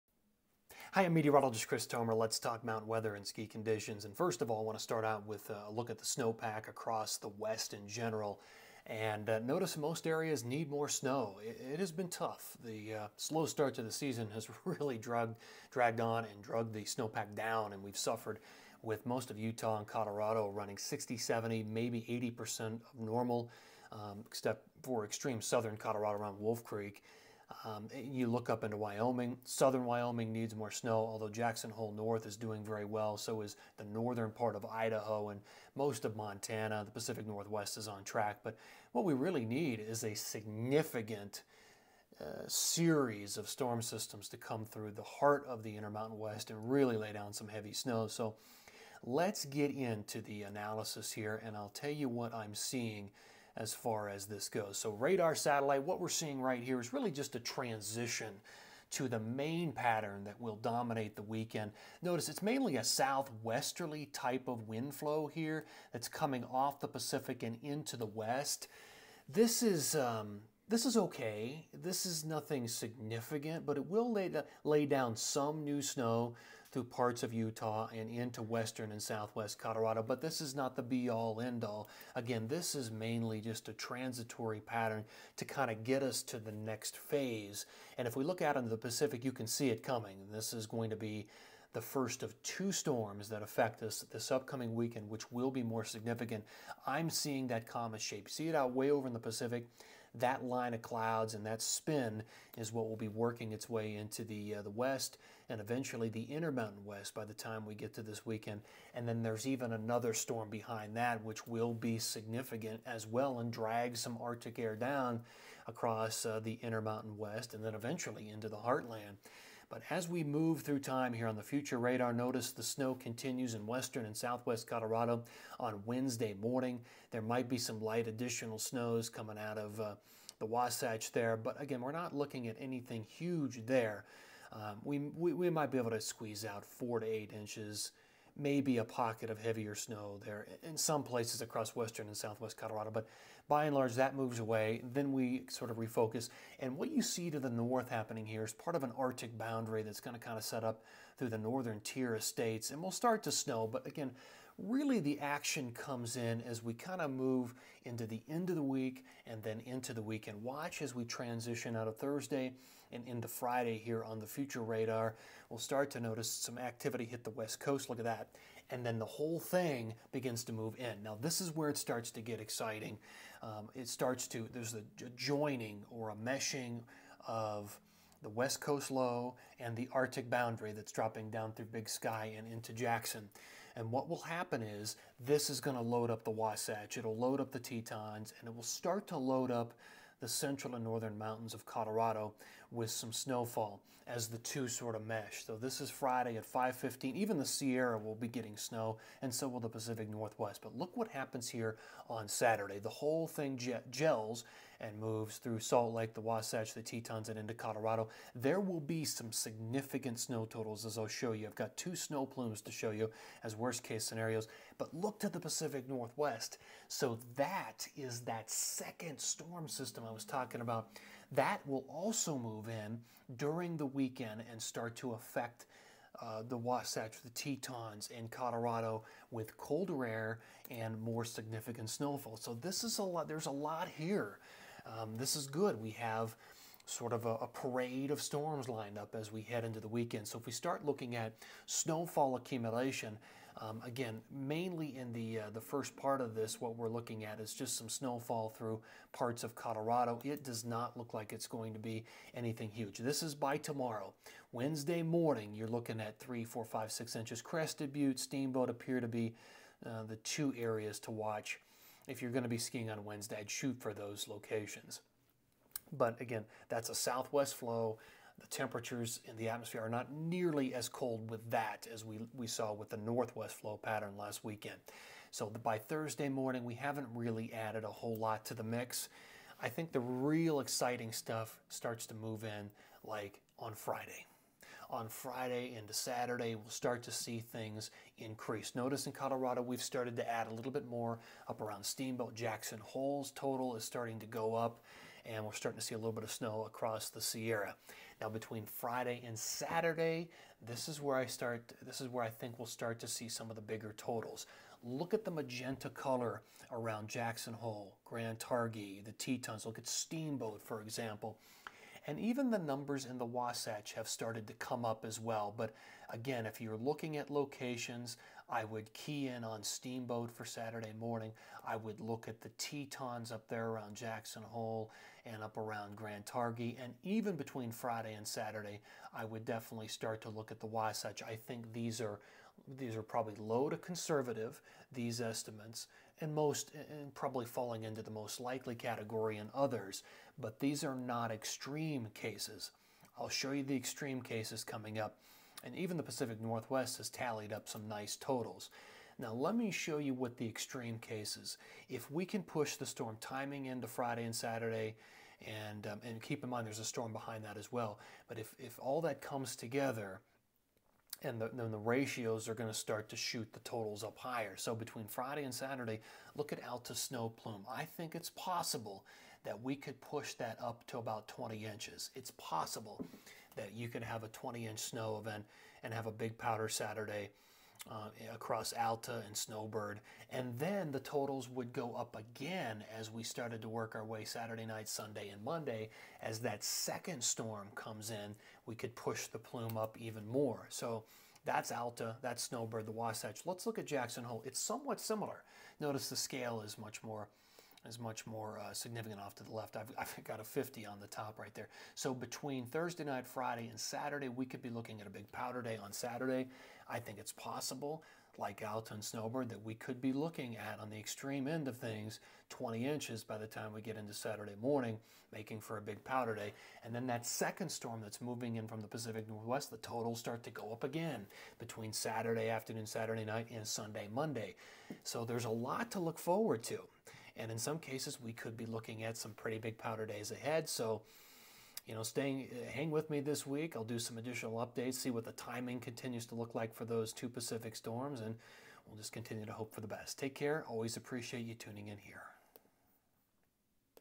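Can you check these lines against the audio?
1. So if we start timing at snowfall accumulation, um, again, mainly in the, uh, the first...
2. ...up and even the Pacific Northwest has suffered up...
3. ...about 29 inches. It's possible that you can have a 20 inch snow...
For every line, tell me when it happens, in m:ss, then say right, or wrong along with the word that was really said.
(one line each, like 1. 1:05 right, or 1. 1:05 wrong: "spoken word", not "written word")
1. 4:00 wrong: "looking", not "timing"
2. 5:44 wrong: "tallied", not "suffered"
3. 6:10 wrong: "20", not "29".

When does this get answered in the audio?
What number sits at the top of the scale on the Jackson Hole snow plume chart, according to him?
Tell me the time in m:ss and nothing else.
6:40.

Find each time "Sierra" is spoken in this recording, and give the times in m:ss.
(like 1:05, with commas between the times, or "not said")
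3:17, 4:57.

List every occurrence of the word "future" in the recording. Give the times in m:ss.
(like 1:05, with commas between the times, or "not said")
2:01, 2:44.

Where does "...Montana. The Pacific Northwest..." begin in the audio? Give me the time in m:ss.
0:36.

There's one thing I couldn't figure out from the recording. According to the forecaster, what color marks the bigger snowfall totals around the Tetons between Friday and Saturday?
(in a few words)
magenta.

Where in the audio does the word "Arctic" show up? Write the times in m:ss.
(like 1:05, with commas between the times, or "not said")
1:54, 2:28, 2:59.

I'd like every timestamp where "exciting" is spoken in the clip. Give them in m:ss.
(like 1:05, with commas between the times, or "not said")
2:52, 4:40.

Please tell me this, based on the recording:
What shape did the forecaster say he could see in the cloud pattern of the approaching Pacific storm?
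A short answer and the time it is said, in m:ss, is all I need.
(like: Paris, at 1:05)
comet shape, at 1:37.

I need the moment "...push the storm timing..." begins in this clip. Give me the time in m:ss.
5:52.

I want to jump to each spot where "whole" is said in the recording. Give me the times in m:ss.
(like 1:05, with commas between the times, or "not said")
2:49, 3:22, 4:37.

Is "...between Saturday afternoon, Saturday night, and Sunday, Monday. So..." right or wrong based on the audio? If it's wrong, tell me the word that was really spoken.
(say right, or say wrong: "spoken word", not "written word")
right.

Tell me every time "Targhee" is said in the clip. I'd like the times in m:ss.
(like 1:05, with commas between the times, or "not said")
5:08, 5:26.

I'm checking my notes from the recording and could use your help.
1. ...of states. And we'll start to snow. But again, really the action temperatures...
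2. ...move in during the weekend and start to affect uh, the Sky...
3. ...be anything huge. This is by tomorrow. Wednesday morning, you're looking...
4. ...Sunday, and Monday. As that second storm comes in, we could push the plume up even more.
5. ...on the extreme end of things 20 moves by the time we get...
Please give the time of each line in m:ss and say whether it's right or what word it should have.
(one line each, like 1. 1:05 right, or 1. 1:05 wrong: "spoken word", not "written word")
1. 2:32 wrong: "comes", not "temperatures"
2. 3:42 wrong: "Wasatch", not "Sky"
3. 4:11 right
4. 6:24 right
5. 6:50 wrong: "inches", not "moves".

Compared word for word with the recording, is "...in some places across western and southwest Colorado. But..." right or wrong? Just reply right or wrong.
right.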